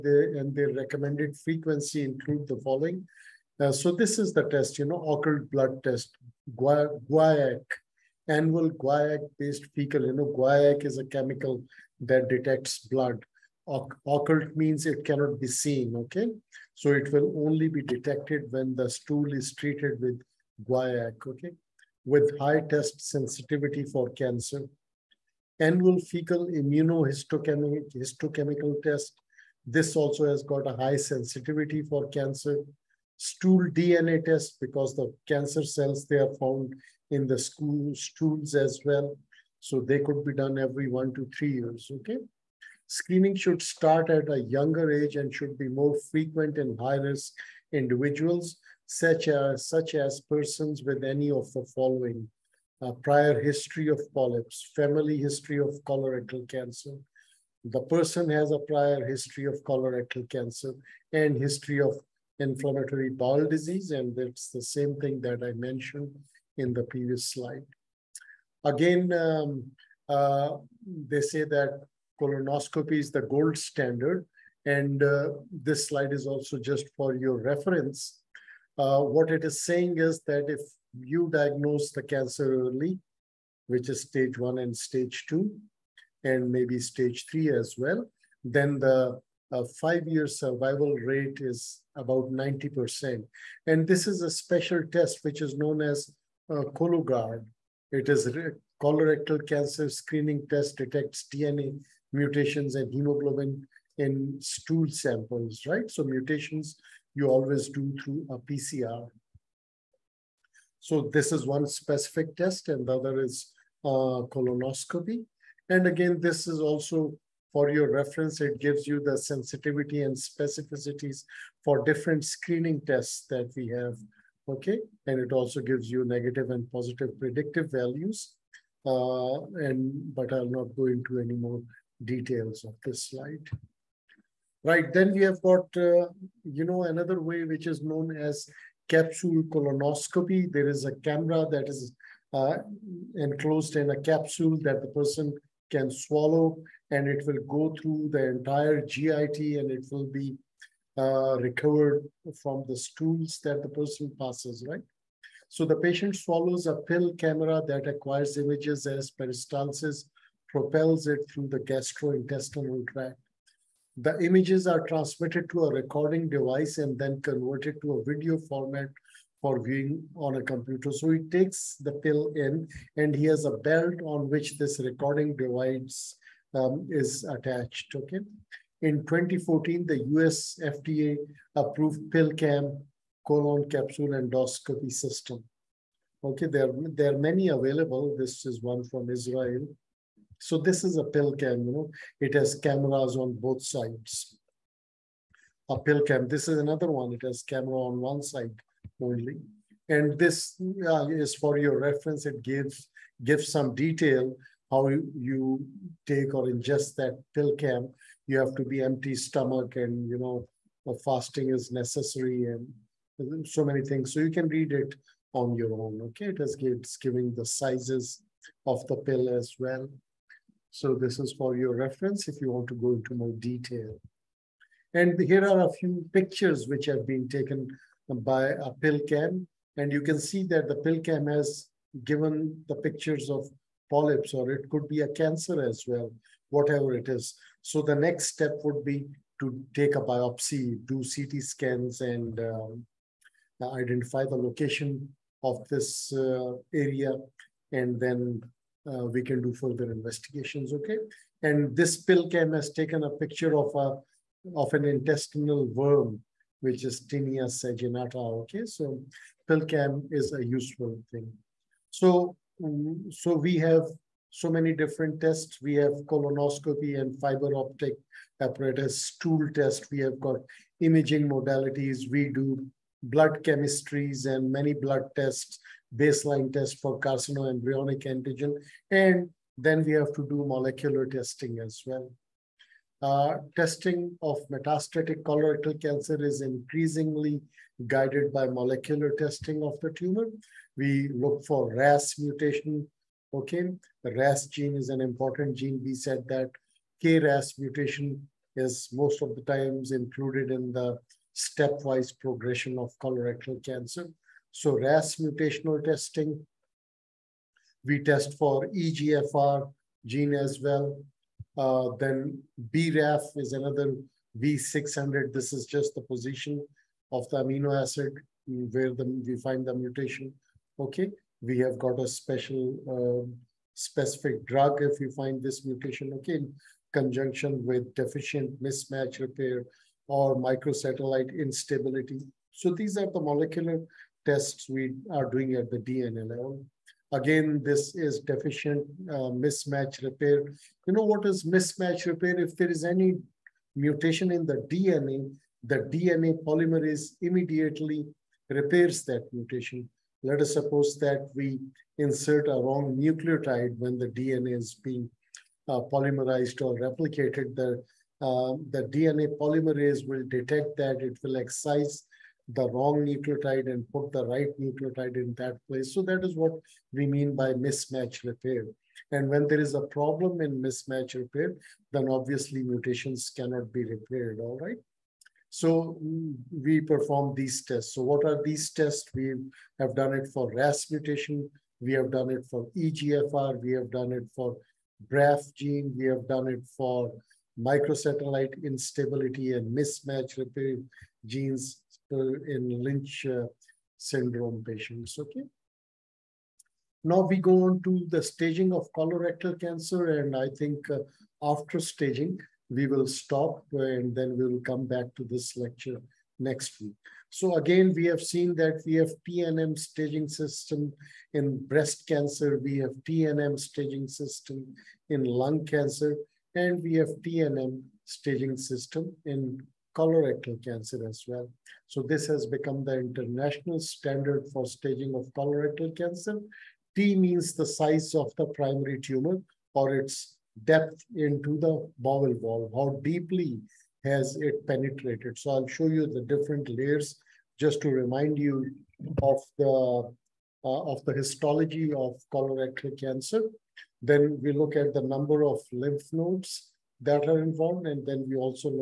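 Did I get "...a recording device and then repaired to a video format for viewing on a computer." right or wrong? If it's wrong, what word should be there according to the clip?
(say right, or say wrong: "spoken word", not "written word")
wrong: "converted", not "repaired".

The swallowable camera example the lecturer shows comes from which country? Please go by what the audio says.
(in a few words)
Israel.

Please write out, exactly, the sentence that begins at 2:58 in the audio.
In 2014, the US FDA approved PillCam colon capsule endoscopy system.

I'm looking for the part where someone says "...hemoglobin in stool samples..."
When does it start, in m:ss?
1:42.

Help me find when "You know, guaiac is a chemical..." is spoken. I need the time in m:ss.
0:10.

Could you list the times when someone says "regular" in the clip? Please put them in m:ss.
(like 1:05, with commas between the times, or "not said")
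not said.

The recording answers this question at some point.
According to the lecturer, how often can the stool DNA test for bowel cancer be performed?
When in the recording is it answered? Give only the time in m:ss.
0:40.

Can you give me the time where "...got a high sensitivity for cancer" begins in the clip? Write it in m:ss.
0:30.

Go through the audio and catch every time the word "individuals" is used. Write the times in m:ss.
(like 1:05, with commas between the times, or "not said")
0:47.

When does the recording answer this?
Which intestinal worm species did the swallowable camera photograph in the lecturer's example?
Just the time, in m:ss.
4:17.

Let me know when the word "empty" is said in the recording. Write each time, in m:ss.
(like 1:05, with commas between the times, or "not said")
3:28.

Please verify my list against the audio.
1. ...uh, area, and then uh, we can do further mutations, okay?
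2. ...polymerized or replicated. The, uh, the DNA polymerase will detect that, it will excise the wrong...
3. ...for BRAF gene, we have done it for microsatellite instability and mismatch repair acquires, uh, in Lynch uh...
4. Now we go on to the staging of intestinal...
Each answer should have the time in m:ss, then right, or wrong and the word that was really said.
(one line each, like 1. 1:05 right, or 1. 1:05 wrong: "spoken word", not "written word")
1. 4:06 wrong: "investigations", not "mutations"
2. 5:55 right
3. 6:24 wrong: "genes", not "acquires"
4. 6:37 wrong: "colorectal", not "intestinal".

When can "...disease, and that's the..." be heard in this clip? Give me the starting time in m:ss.
1:03.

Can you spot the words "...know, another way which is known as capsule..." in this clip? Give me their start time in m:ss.
2:16.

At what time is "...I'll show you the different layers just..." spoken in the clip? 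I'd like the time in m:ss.
7:15.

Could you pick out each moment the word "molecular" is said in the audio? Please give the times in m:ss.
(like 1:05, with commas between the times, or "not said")
4:40, 4:48, 5:33.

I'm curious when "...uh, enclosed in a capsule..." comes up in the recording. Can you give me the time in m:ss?
2:22.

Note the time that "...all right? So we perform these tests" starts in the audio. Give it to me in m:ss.
6:14.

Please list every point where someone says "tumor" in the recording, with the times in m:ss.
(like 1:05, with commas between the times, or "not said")
4:49, 7:08.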